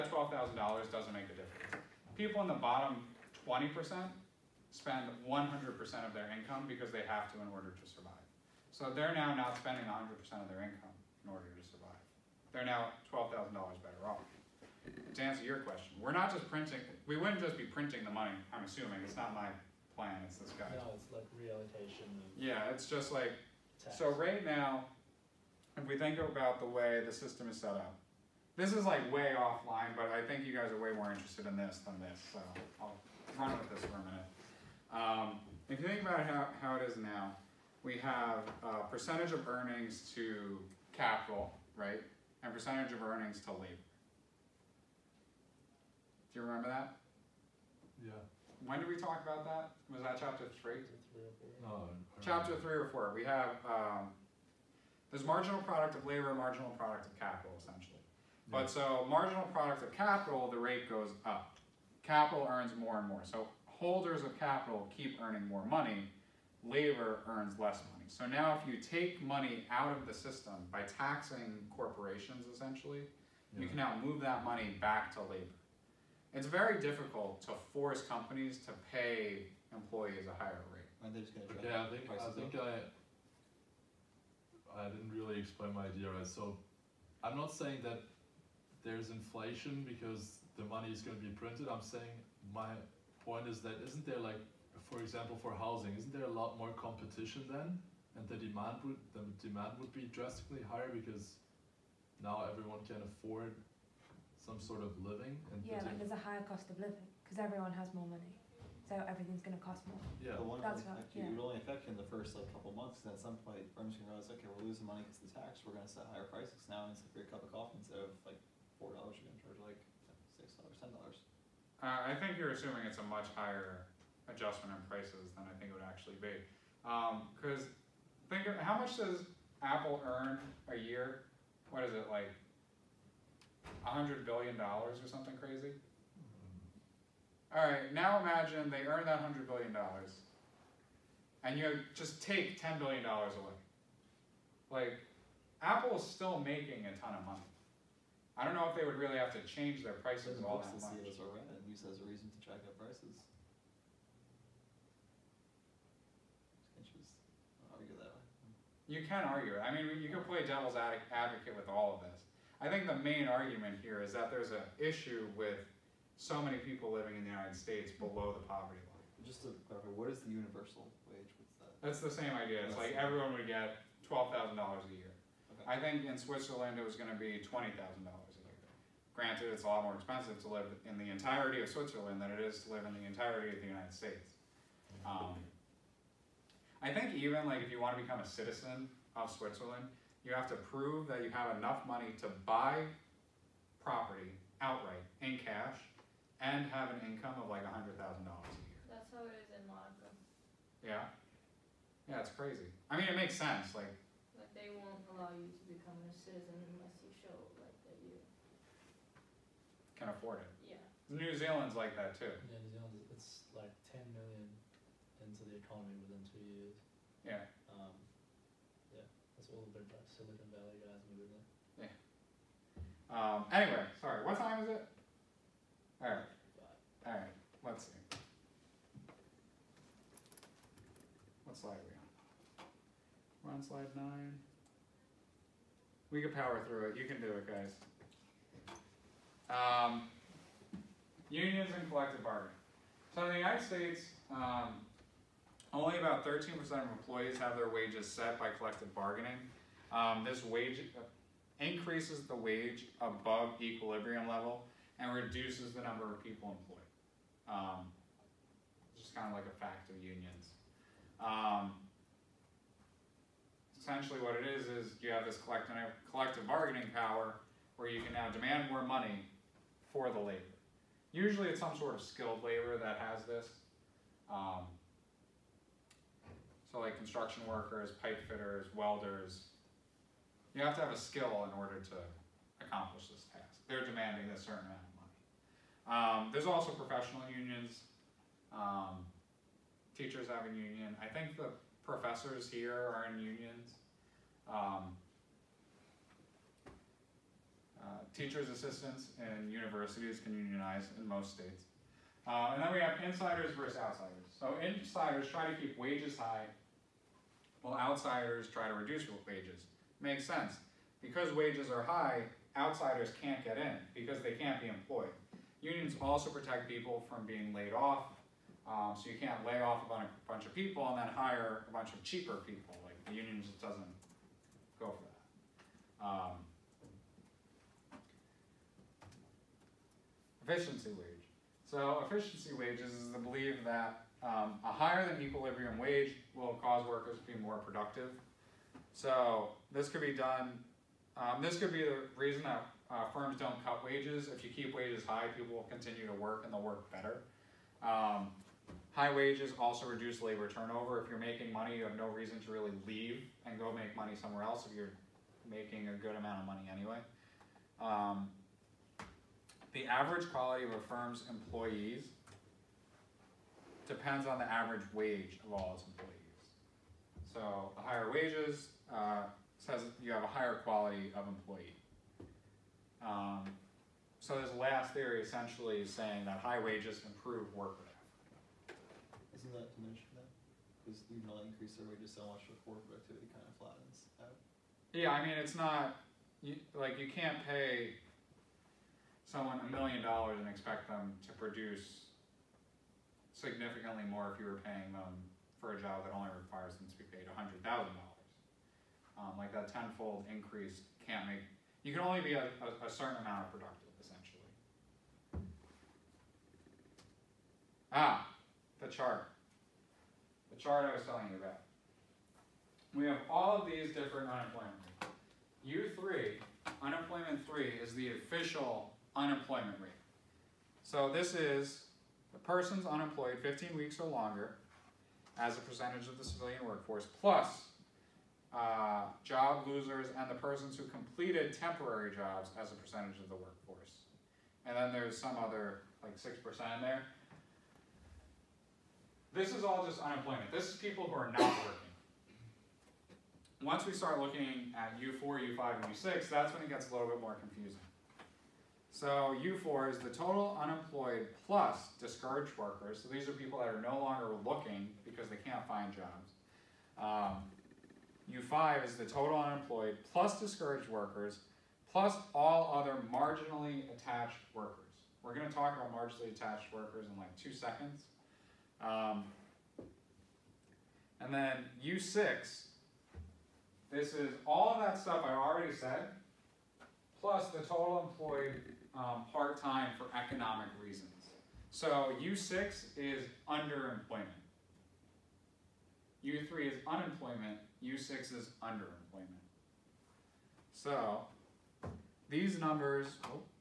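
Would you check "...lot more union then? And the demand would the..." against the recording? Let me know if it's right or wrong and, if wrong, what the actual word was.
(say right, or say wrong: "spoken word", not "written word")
wrong: "competition", not "union".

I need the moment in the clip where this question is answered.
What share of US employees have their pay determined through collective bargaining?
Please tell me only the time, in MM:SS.
04:06.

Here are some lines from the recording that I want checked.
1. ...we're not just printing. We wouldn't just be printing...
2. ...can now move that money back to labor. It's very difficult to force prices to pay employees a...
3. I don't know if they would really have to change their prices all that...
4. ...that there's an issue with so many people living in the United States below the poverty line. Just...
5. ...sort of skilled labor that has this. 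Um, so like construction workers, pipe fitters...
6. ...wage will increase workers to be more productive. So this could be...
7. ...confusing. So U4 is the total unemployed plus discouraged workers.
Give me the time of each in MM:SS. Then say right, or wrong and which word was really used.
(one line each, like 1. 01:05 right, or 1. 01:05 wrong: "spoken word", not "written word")
1. 00:15 right
2. 01:13 wrong: "companies", not "prices"
3. 02:28 right
4. 02:44 right
5. 04:31 right
6. 05:35 wrong: "cause", not "increase"
7. 07:27 right.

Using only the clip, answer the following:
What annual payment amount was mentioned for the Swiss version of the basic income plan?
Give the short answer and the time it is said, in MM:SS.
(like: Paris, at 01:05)
$20,000, at 02:57.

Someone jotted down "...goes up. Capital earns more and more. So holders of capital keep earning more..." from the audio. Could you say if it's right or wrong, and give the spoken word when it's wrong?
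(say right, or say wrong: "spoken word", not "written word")
right.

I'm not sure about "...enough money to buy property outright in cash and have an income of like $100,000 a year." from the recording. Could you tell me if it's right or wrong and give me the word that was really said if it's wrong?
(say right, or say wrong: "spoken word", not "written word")
right.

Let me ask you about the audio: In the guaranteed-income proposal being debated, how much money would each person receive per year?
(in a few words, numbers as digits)
$12,000.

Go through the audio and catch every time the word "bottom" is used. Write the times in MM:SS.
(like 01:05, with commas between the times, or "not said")
00:02.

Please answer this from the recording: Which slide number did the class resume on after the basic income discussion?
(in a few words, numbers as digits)
9.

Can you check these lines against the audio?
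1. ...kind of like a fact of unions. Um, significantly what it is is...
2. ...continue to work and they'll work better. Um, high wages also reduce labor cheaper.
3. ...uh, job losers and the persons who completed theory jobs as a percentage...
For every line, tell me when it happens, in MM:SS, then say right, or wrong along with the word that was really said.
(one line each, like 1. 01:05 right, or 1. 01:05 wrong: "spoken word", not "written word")
1. 04:19 wrong: "essentially", not "significantly"
2. 05:45 wrong: "turnover", not "cheaper"
3. 07:08 wrong: "temporary", not "theory".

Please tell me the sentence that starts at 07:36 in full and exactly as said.
Um, U5 is the total unemployed plus discouraged workers plus all other marginally attached workers.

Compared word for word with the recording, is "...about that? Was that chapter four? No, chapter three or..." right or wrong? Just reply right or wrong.
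wrong.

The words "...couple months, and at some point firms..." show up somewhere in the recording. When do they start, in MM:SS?
01:52.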